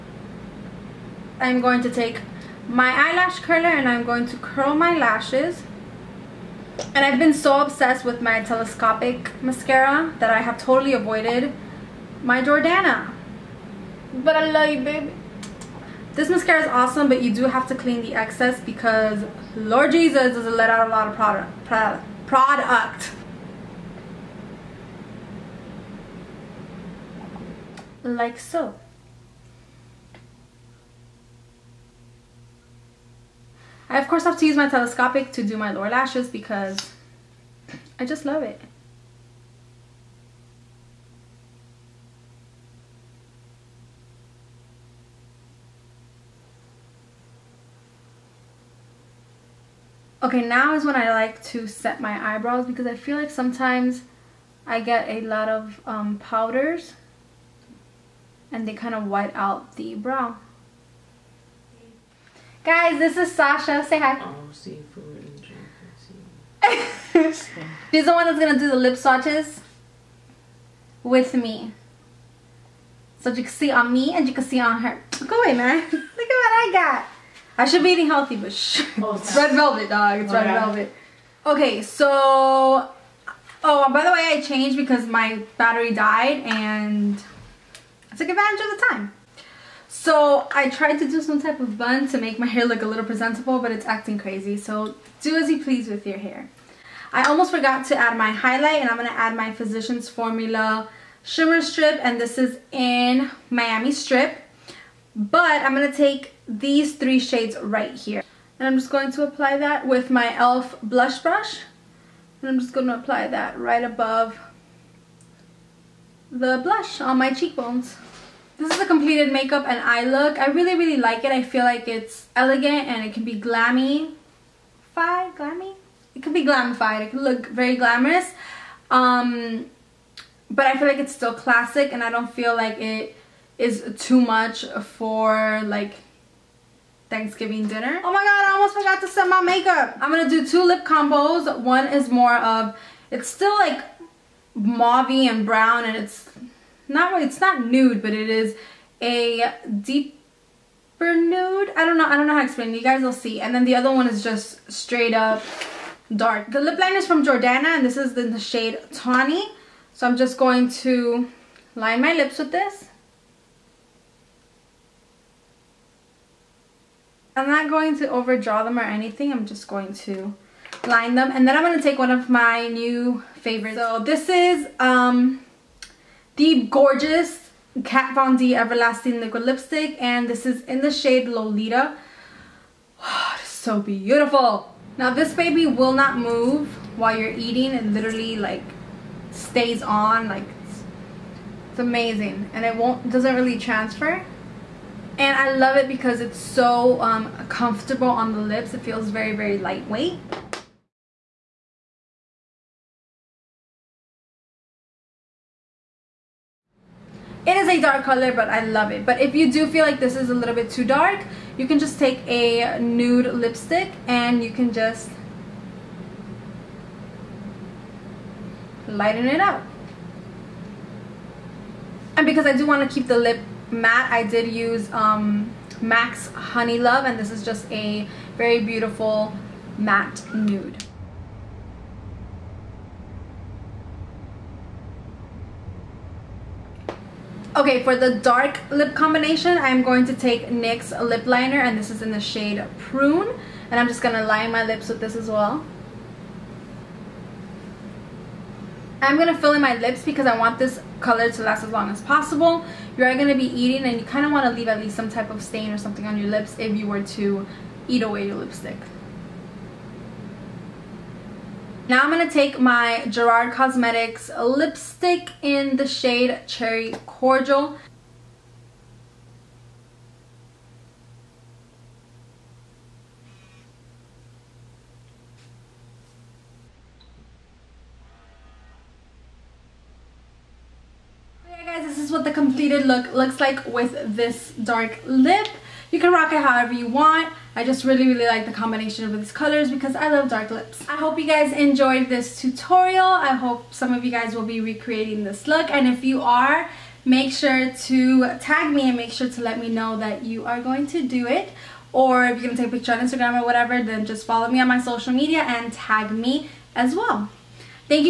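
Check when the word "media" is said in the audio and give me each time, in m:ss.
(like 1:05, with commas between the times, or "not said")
5:05.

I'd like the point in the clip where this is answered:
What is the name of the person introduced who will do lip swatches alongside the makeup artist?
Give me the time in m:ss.
1:03.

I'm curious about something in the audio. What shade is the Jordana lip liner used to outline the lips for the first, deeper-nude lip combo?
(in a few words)
Tawny.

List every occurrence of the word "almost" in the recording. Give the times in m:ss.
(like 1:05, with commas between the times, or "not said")
1:37, 2:18.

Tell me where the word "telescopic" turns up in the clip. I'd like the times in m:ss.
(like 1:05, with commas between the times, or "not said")
0:08, 0:34.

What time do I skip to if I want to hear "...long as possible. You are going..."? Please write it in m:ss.
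4:11.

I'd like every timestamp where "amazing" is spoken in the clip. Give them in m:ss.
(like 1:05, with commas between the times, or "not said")
3:11.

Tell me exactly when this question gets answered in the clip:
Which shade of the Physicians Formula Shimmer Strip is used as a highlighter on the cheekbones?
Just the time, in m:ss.
1:43.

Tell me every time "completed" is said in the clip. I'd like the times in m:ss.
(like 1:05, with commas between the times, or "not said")
1:58, 4:42.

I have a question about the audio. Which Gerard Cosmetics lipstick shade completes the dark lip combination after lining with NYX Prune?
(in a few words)
Cherry Cordial.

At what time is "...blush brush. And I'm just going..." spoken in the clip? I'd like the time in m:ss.
1:50.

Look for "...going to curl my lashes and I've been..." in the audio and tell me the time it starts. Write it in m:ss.
0:04.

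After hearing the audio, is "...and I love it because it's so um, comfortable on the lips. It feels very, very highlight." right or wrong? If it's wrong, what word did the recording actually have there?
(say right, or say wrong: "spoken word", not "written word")
wrong: "lightweight", not "highlight".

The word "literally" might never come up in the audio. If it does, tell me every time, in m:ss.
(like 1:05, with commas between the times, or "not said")
3:07.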